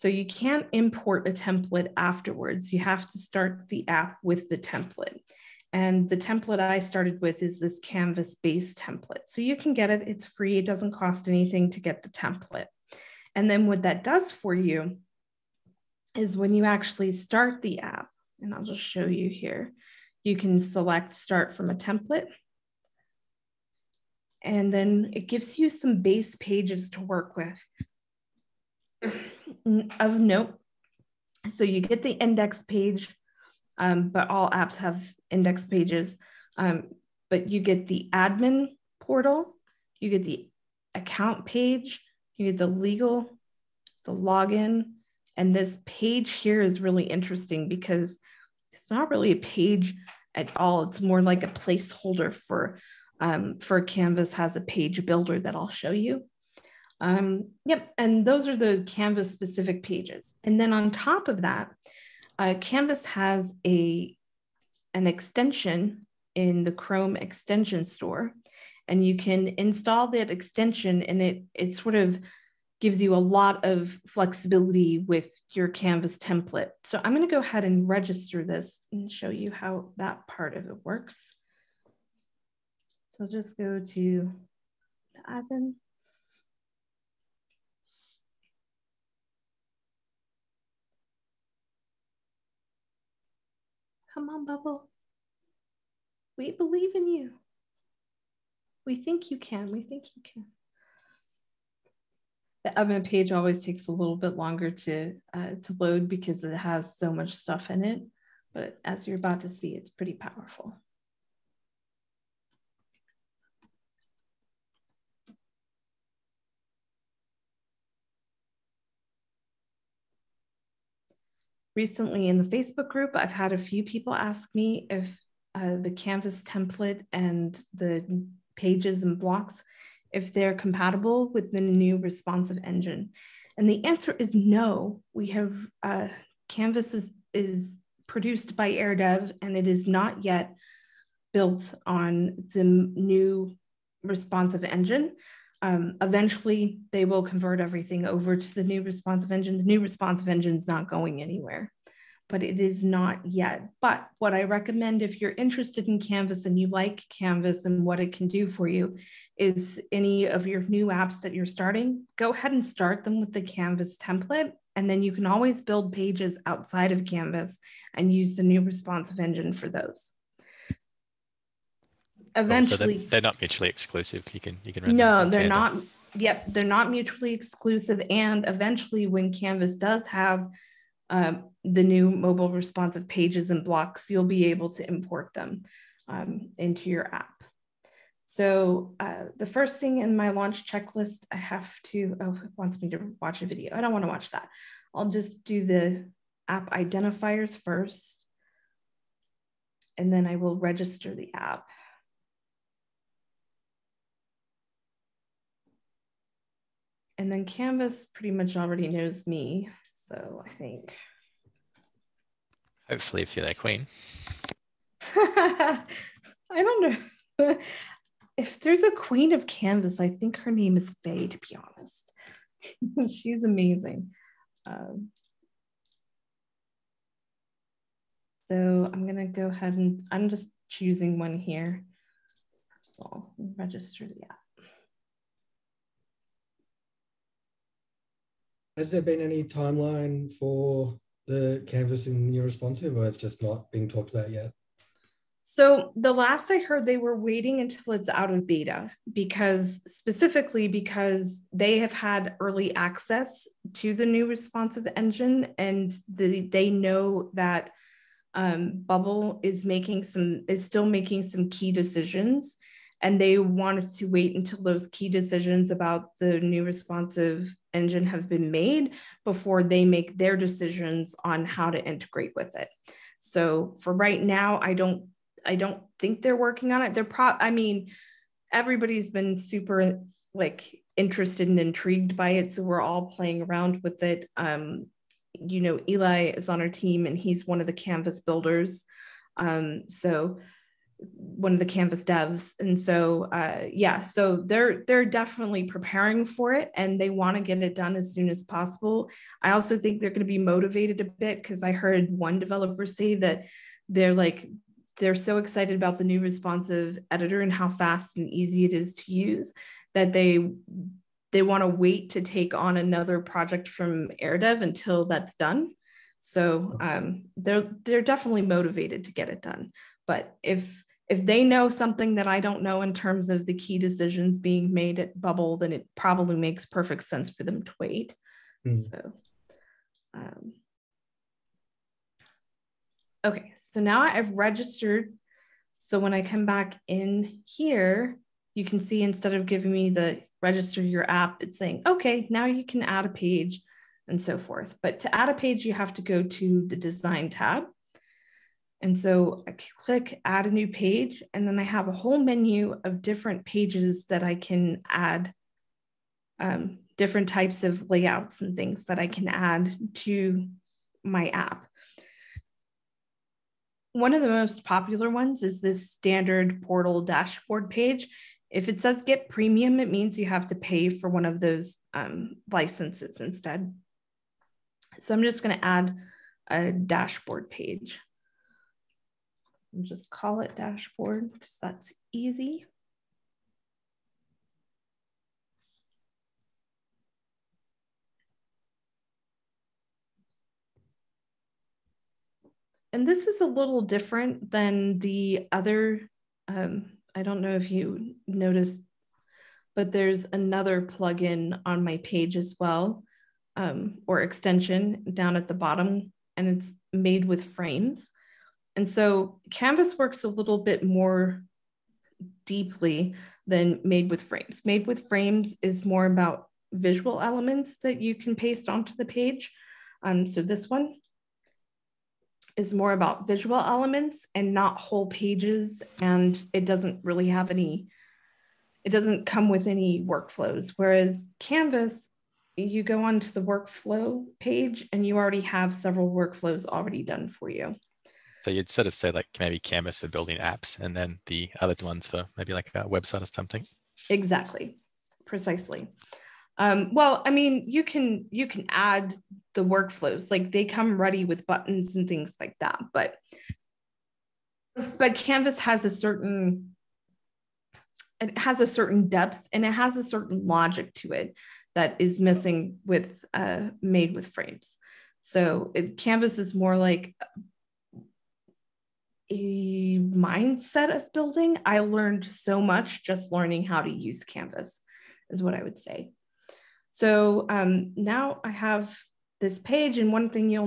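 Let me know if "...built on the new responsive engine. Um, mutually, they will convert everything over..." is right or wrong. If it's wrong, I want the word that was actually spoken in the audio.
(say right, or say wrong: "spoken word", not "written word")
wrong: "eventually", not "mutually".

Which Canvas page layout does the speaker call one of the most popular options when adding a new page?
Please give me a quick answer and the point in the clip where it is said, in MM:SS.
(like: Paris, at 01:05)
Standard portal dashboard, at 06:05.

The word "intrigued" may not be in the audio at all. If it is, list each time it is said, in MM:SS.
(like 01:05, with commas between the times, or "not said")
04:41.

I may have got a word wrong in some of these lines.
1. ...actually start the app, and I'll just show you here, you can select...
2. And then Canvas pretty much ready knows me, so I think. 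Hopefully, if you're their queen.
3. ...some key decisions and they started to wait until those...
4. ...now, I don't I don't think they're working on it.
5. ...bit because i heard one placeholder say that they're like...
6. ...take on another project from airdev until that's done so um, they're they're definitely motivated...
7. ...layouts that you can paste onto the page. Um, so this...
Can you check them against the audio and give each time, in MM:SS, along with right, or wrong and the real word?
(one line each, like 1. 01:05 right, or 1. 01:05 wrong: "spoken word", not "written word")
1. 00:16 right
2. 03:27 wrong: "already", not "ready"
3. 04:21 wrong: "wanted", not "started"
4. 04:34 right
5. 05:01 wrong: "developer", not "placeholder"
6. 05:12 right
7. 06:57 wrong: "elements", not "layouts".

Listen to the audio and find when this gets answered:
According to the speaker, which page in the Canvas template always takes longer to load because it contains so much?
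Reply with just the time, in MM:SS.
01:42.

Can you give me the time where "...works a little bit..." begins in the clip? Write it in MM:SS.
06:49.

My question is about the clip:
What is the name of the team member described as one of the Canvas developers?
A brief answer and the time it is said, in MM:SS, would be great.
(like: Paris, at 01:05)
Eli, at 04:45.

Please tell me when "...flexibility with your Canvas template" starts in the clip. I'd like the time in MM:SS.
01:14.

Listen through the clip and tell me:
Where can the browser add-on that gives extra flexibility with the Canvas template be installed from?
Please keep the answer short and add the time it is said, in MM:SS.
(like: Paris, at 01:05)
Chrome extension store, at 01:06.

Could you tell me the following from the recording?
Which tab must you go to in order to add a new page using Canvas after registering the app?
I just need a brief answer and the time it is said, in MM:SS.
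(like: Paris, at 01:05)
The design tab, at 05:46.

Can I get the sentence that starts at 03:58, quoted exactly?
Has there been any timeline for the canvas in your responsive, or it's just not being talked about yet?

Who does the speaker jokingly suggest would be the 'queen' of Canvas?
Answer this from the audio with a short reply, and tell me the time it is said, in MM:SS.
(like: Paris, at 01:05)
Faye, at 03:41.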